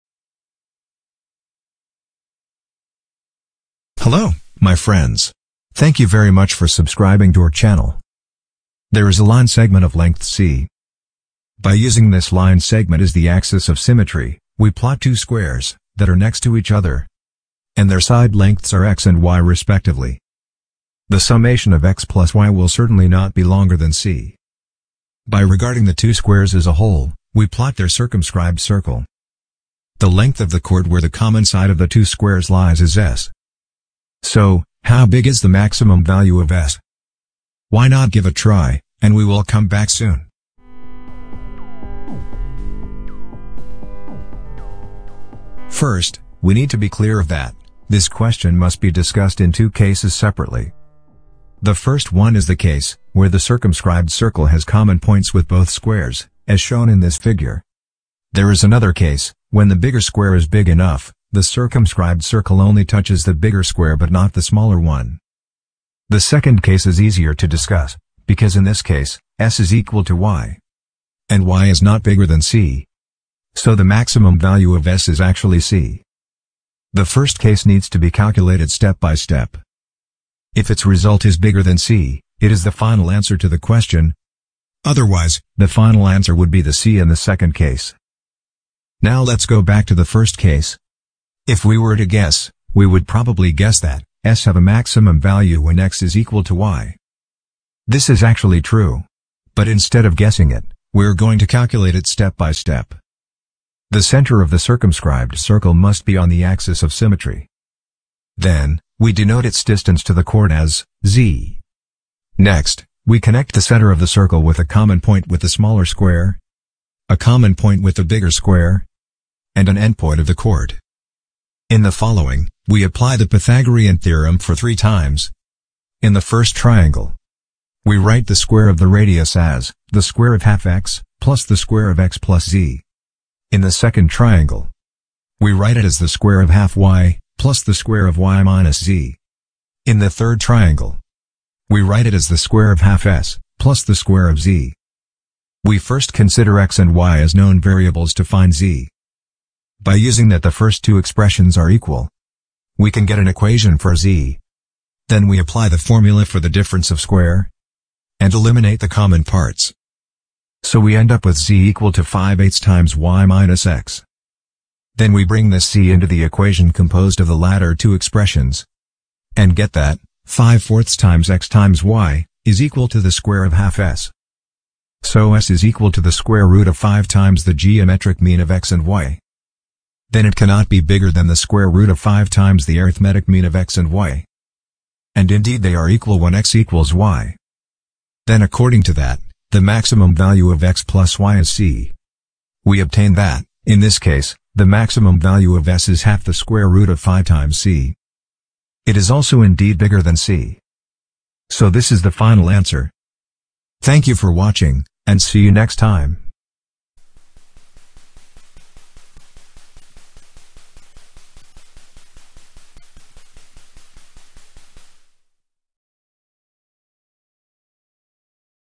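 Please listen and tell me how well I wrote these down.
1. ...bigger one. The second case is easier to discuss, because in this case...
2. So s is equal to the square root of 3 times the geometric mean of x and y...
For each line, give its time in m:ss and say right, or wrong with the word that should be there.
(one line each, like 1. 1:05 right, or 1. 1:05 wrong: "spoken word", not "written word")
1. 1:04 wrong: "smaller", not "bigger"
2. 2:55 wrong: "5", not "3".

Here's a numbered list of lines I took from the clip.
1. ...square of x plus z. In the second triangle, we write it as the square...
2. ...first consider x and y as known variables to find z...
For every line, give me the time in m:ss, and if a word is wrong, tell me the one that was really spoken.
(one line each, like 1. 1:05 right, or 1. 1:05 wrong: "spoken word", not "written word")
1. 2:11 right
2. 2:25 right.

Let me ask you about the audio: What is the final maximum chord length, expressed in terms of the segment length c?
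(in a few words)
half the square root of 5 times c.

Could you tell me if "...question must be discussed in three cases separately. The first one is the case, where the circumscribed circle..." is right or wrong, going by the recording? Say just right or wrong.
wrong.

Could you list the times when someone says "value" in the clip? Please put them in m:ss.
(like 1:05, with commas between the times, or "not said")
0:36, 1:14, 1:35, 3:10, 3:15.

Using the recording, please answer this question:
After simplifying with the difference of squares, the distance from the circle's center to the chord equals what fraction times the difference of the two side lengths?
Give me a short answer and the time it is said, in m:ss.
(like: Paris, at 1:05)
5/8, at 2:42.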